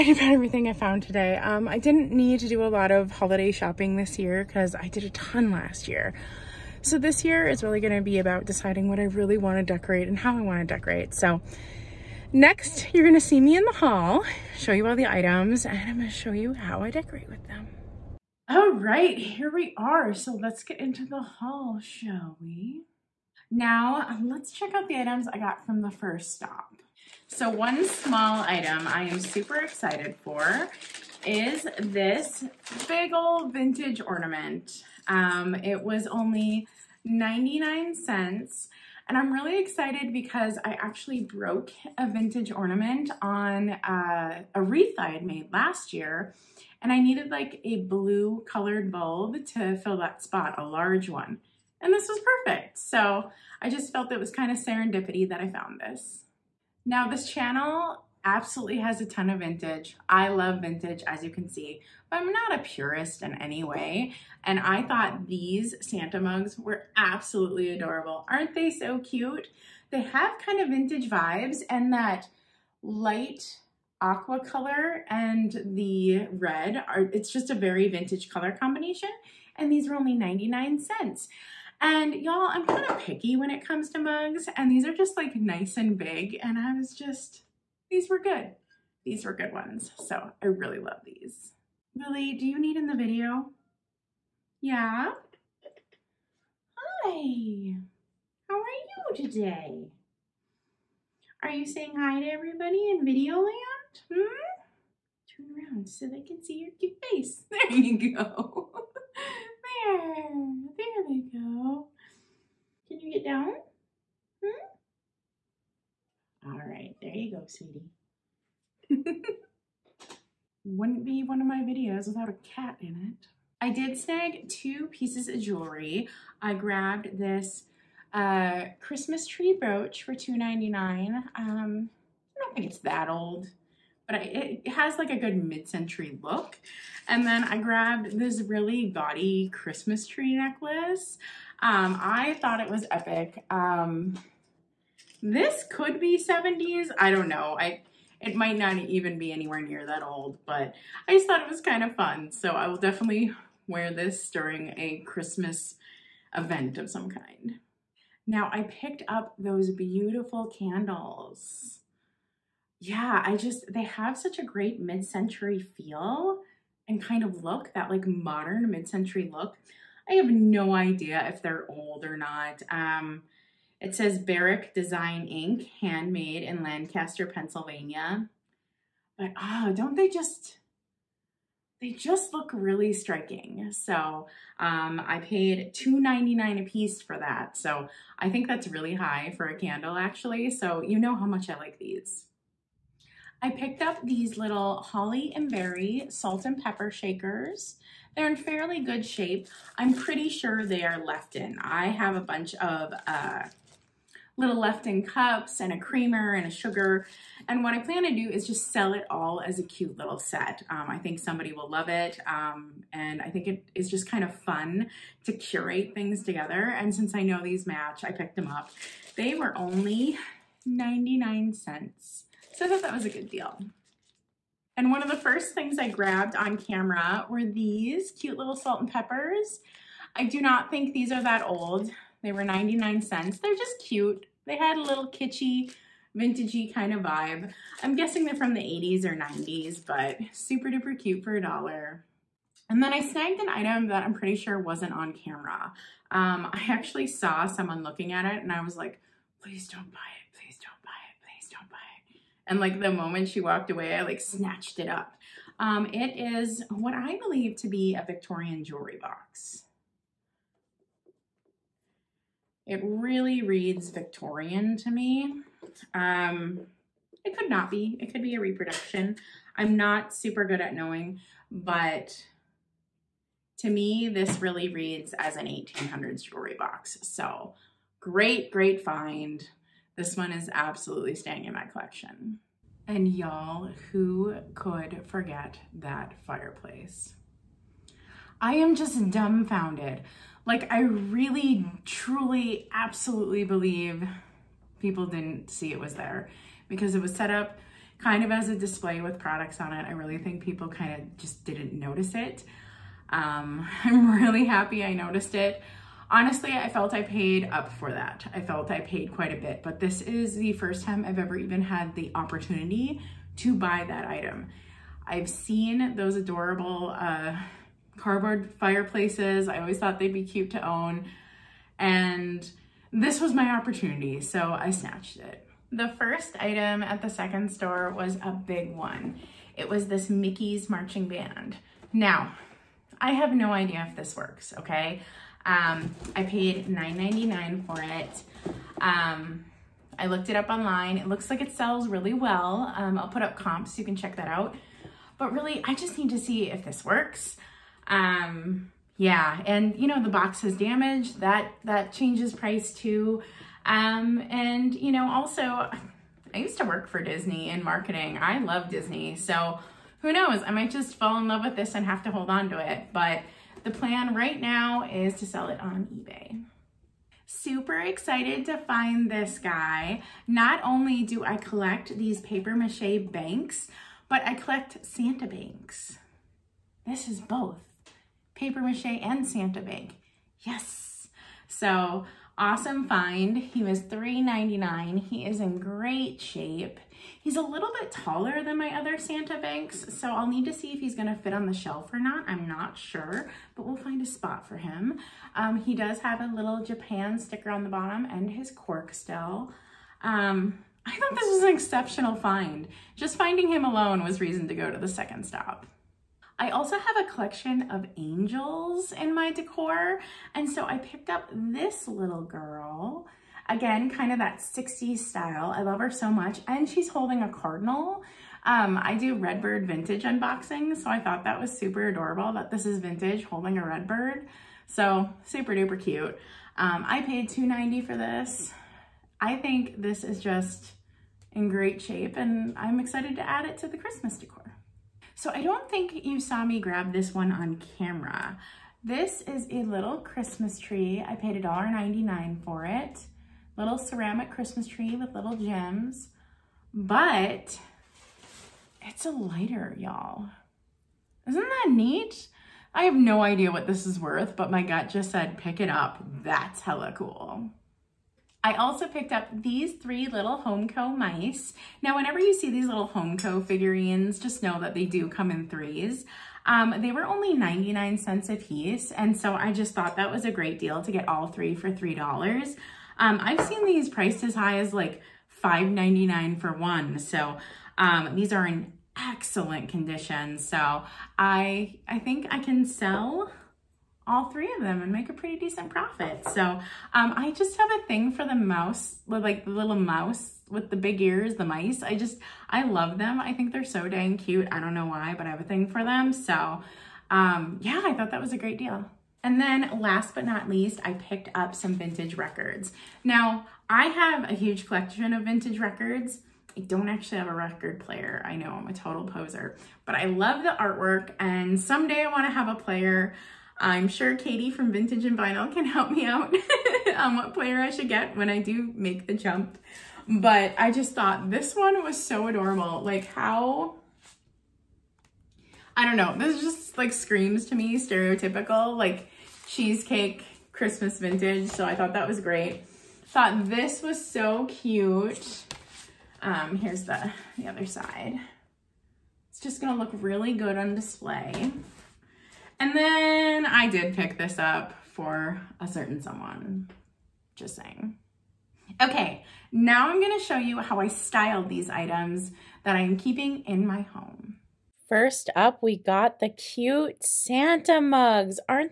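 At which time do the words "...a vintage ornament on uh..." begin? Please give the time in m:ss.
0:41.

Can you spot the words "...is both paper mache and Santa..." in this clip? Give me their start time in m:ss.
6:17.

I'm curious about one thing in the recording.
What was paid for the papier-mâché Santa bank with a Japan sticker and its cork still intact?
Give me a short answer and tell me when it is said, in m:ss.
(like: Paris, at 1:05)
$3.99, at 6:23.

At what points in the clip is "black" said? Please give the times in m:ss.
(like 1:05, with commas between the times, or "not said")
not said.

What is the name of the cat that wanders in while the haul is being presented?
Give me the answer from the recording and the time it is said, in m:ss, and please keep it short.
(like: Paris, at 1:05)
Lily, at 1:31.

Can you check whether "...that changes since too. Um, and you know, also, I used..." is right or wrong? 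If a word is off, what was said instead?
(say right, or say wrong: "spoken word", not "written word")
wrong: "price", not "since".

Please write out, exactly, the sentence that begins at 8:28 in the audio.
I know I'm a total poser, but I love the artwork and someday I wanna have a player.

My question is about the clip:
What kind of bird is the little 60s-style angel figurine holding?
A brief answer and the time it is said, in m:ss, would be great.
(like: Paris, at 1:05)
a cardinal, at 6:57.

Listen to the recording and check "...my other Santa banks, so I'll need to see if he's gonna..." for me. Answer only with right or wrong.
right.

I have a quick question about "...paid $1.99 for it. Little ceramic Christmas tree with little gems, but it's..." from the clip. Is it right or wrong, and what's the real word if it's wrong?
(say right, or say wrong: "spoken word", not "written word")
right.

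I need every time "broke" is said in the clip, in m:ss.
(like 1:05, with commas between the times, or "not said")
0:41.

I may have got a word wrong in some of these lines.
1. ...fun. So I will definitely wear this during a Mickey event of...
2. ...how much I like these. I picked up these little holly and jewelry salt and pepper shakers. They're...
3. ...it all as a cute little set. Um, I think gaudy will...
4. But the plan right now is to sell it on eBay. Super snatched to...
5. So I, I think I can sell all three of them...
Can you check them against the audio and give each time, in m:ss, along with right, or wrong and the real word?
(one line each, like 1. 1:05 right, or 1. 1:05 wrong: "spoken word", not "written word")
1. 2:31 wrong: "Christmas", not "Mickey"
2. 3:11 wrong: "berry", not "jewelry"
3. 3:28 wrong: "somebody", not "gaudy"
4. 6:02 wrong: "excited", not "snatched"
5. 8:00 right.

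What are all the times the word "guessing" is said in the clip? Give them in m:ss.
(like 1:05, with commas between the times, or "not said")
3:57.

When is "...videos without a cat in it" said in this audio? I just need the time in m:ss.
2:01.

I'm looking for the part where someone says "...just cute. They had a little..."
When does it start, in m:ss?
3:53.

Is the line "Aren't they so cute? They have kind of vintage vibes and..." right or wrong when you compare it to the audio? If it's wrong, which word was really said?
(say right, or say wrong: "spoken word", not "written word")
right.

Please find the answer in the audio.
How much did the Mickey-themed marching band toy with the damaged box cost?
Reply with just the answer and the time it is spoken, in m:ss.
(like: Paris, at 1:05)
$9.99, at 5:36.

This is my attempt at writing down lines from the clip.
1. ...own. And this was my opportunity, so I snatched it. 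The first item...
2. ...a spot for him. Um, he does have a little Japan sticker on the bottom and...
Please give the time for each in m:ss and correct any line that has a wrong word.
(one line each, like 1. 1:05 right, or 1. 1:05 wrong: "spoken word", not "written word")
1. 5:20 right
2. 6:34 right.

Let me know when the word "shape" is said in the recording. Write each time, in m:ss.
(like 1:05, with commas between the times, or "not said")
3:19, 6:26, 7:11.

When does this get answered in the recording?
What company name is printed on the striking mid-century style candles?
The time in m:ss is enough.
2:54.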